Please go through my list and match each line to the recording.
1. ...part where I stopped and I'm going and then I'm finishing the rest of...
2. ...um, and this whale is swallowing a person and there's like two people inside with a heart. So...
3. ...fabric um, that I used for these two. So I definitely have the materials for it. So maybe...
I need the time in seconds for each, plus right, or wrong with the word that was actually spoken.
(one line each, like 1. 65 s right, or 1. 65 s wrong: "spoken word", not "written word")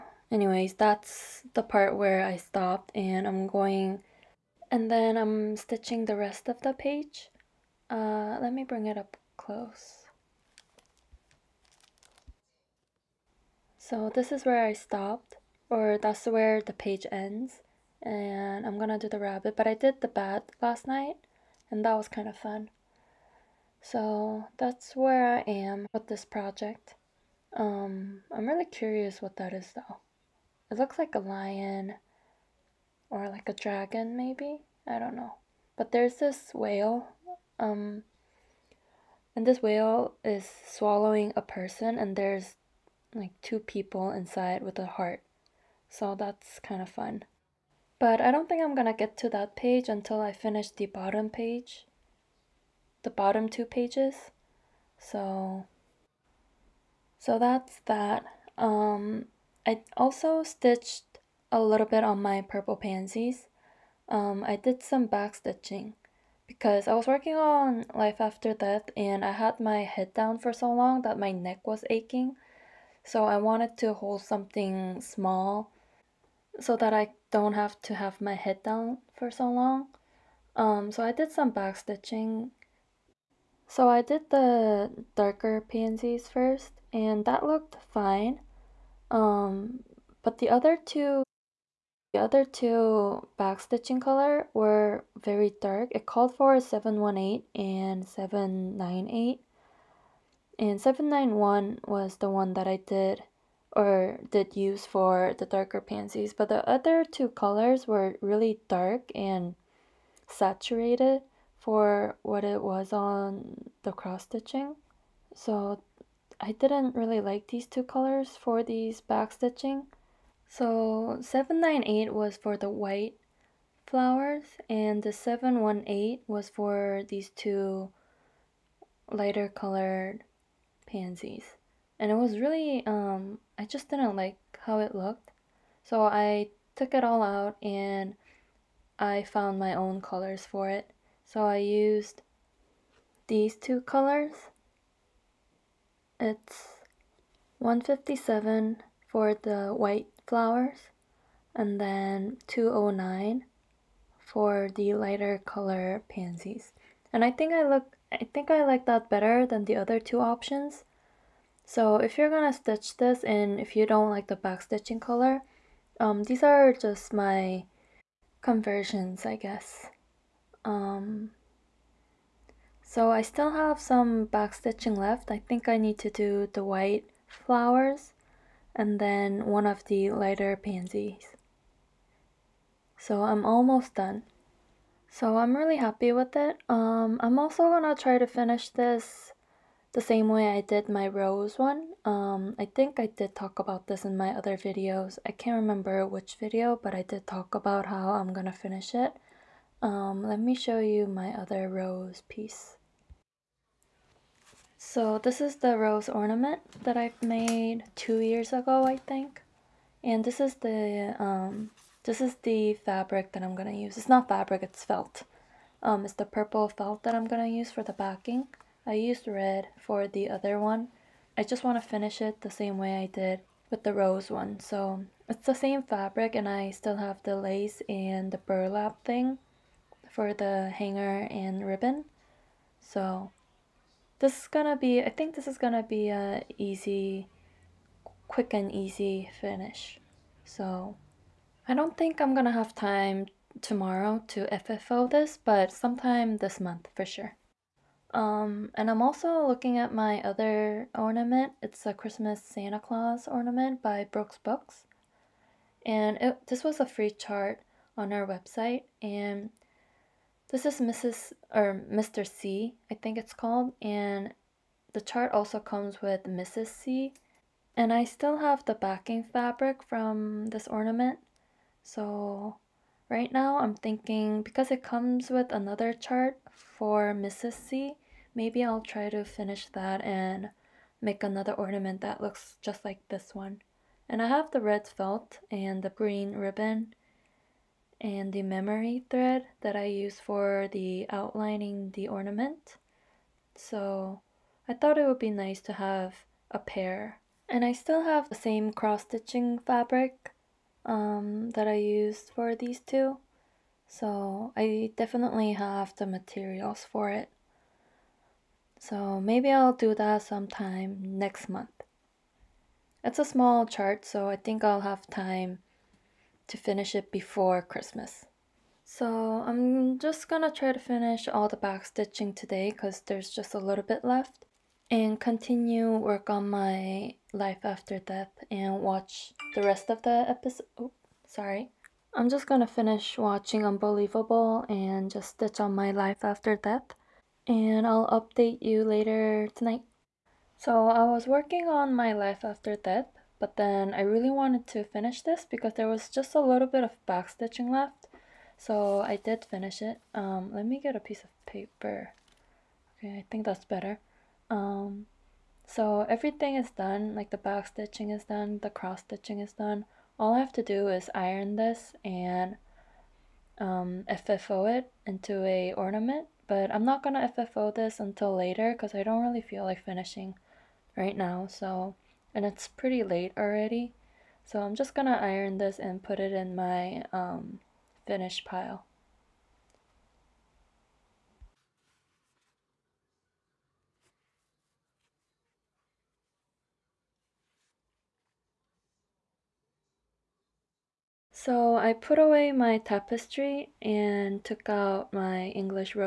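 1. 1 s wrong: "stitching", not "finishing"
2. 37 s right
3. 299 s right.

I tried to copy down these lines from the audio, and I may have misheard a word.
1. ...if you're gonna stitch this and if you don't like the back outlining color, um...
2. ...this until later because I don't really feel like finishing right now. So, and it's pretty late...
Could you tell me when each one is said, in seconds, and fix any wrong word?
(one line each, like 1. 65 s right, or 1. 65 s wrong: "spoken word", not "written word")
1. 161 s wrong: "stitching", not "outlining"
2. 367 s right.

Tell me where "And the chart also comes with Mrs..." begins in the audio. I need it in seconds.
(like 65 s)
263 s.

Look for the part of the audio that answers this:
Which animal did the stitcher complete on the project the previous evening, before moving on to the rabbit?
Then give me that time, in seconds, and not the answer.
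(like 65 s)
20 s.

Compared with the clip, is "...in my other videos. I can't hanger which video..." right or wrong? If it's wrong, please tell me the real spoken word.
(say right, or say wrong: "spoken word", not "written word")
wrong: "remember", not "hanger".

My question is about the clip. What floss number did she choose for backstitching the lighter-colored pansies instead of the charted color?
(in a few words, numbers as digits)
209.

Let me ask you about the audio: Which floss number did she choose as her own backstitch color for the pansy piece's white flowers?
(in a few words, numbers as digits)
157.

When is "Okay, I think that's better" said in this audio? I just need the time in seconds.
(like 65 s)
352 s.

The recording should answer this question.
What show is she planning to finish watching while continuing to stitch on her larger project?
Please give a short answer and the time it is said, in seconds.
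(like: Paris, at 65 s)
Unbelievable, at 333 s.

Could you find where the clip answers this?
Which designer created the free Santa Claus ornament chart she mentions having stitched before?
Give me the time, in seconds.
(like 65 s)
254 s.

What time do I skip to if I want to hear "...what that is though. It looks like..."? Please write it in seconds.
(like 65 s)
29 s.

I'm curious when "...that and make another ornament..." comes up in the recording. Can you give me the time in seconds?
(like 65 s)
279 s.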